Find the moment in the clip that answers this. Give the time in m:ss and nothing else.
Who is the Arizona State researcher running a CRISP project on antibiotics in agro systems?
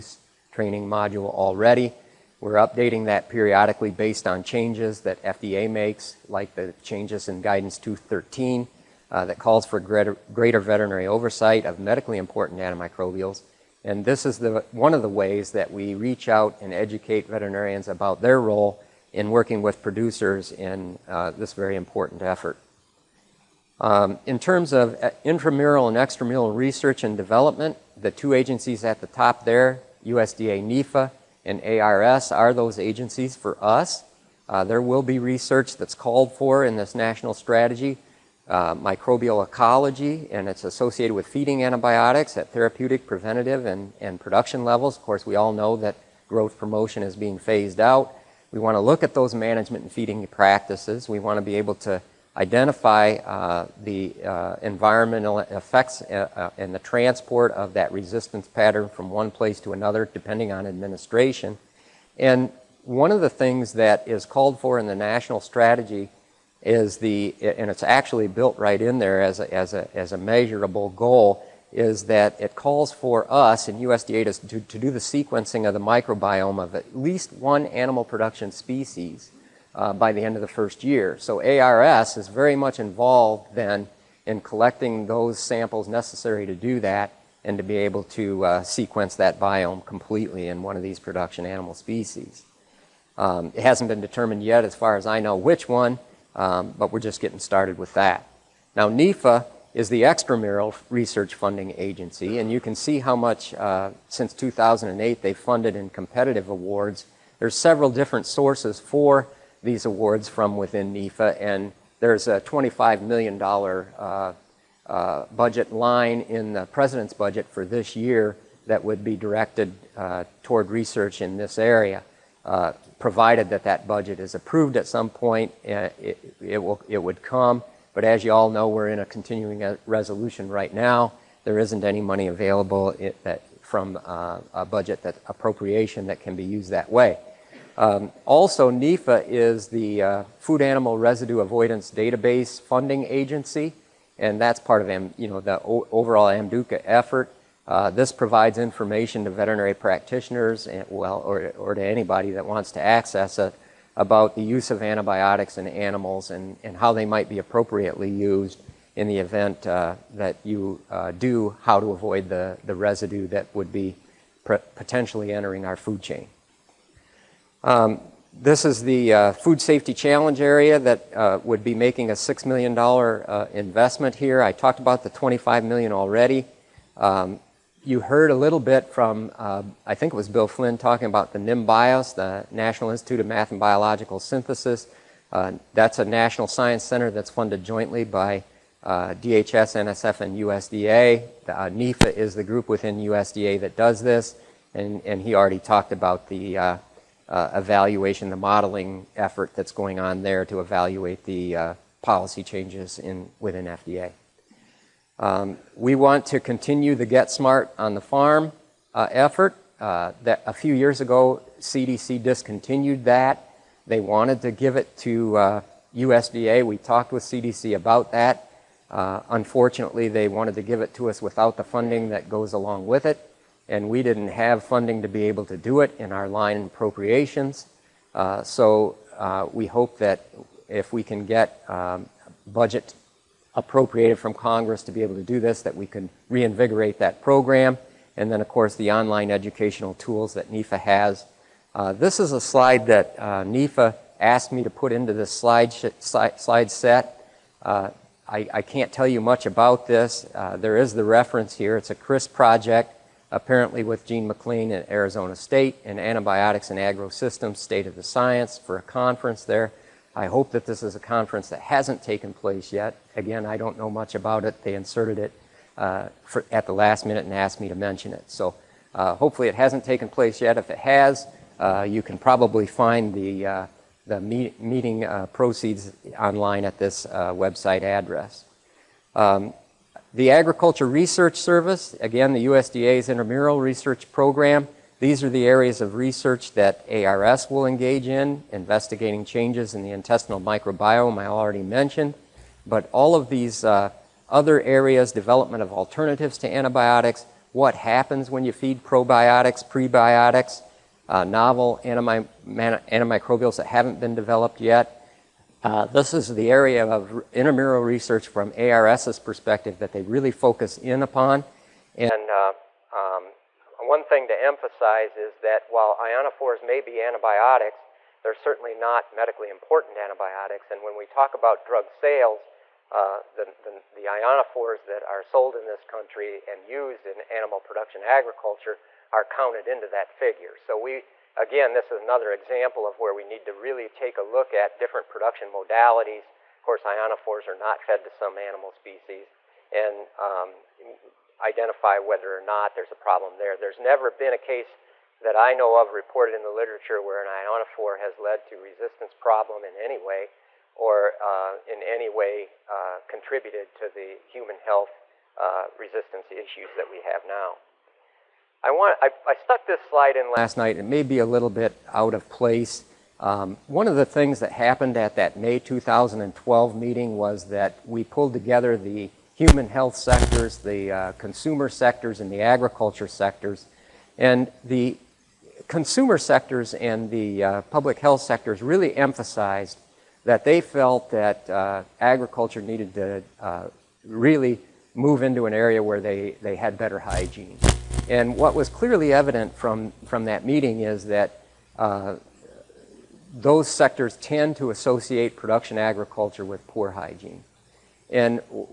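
4:14.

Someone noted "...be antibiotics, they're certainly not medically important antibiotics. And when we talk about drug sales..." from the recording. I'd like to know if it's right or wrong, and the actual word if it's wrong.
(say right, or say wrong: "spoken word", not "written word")
right.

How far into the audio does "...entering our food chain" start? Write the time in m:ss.
2:45.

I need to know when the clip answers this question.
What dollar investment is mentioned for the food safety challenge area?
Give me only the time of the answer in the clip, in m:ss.
2:52.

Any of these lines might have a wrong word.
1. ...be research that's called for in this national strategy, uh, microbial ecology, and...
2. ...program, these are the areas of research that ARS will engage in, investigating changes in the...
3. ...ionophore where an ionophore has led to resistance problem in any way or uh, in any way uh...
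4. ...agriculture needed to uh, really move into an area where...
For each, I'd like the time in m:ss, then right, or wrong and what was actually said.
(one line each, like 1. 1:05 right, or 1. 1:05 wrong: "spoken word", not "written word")
1. 0:35 right
2. 4:44 right
3. 5:46 wrong: "literature", not "ionophore"
4. 6:21 right.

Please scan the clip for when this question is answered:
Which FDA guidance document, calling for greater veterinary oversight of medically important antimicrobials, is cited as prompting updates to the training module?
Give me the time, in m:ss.
0:07.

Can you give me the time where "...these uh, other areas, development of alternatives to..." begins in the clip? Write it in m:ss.
4:53.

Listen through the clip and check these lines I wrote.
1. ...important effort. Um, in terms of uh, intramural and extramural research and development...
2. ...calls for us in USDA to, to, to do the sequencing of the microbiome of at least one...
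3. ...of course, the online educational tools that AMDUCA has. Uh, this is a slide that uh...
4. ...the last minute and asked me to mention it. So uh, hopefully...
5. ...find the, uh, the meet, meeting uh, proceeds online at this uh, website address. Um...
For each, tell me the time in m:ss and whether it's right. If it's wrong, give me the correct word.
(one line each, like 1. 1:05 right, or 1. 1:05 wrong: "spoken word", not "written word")
1. 0:21 right
2. 1:12 right
3. 3:58 wrong: "NIFA", not "AMDUCA"
4. 4:26 right
5. 4:32 right.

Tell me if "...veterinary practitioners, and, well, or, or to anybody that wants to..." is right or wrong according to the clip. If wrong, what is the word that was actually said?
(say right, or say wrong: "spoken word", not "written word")
right.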